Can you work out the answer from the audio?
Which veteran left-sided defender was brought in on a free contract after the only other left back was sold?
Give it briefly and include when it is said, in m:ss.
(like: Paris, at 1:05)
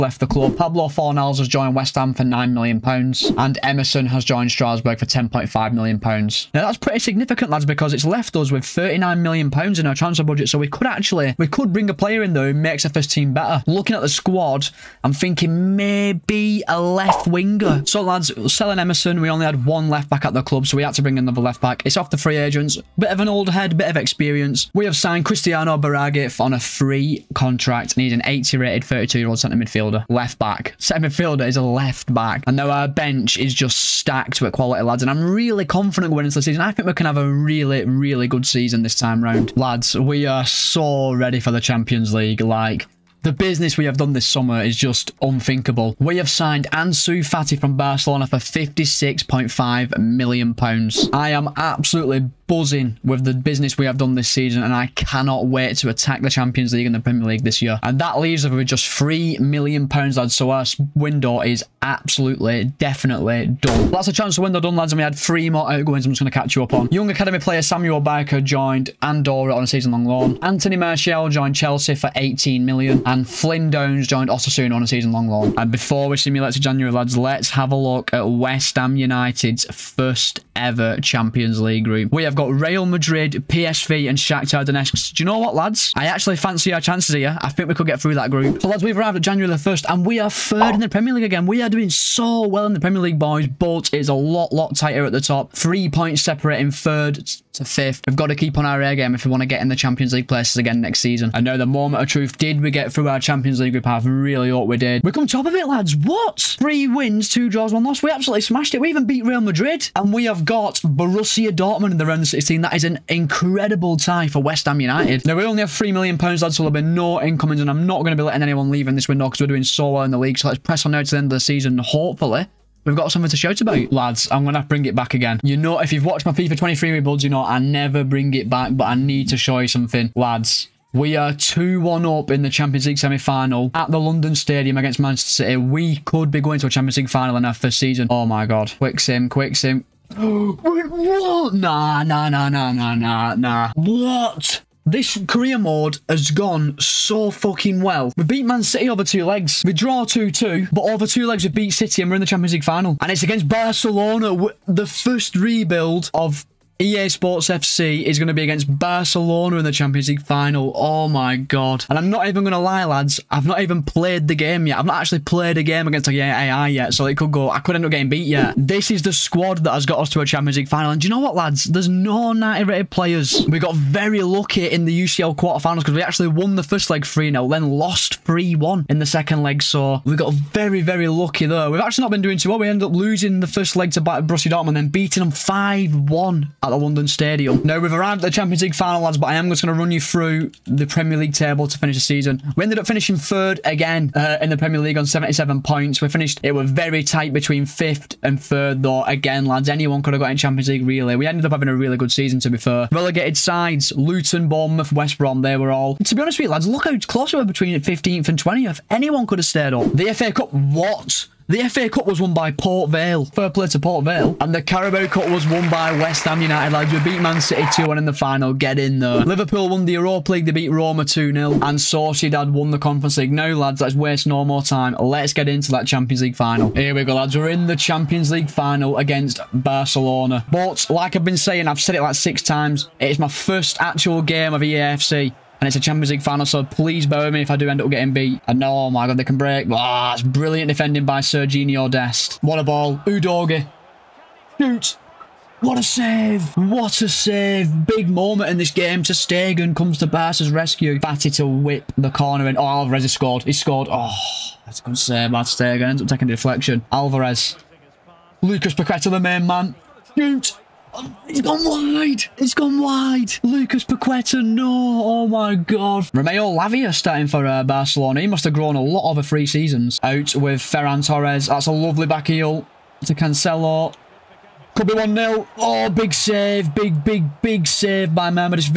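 Cristiano Biraghi, at 0:25.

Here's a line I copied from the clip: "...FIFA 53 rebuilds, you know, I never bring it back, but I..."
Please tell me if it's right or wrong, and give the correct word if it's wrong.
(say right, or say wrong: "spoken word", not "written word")
wrong: "23", not "53".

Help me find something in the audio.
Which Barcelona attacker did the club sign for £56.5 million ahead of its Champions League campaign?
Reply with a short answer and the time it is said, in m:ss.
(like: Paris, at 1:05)
Ansu Fati, at 0:46.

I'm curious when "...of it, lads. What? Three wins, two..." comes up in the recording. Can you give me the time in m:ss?
1:45.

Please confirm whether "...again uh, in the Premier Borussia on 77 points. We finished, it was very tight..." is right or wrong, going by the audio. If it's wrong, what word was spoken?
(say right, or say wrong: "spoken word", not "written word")
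wrong: "League", not "Borussia".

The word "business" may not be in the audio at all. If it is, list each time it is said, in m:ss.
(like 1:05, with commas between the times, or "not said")
0:43, 0:53.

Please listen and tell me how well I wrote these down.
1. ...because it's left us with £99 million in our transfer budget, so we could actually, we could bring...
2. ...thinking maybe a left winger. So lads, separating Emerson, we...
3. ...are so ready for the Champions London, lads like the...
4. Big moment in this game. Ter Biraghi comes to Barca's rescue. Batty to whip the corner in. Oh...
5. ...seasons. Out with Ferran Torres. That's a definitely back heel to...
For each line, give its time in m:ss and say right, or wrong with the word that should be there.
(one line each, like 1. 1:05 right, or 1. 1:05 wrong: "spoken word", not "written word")
1. 0:07 wrong: "39", not "99"
2. 0:15 wrong: "selling", not "separating"
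3. 0:40 wrong: "League", not "London"
4. 4:07 wrong: "Stegen", not "Biraghi"
5. 4:29 wrong: "lovely", not "definitely".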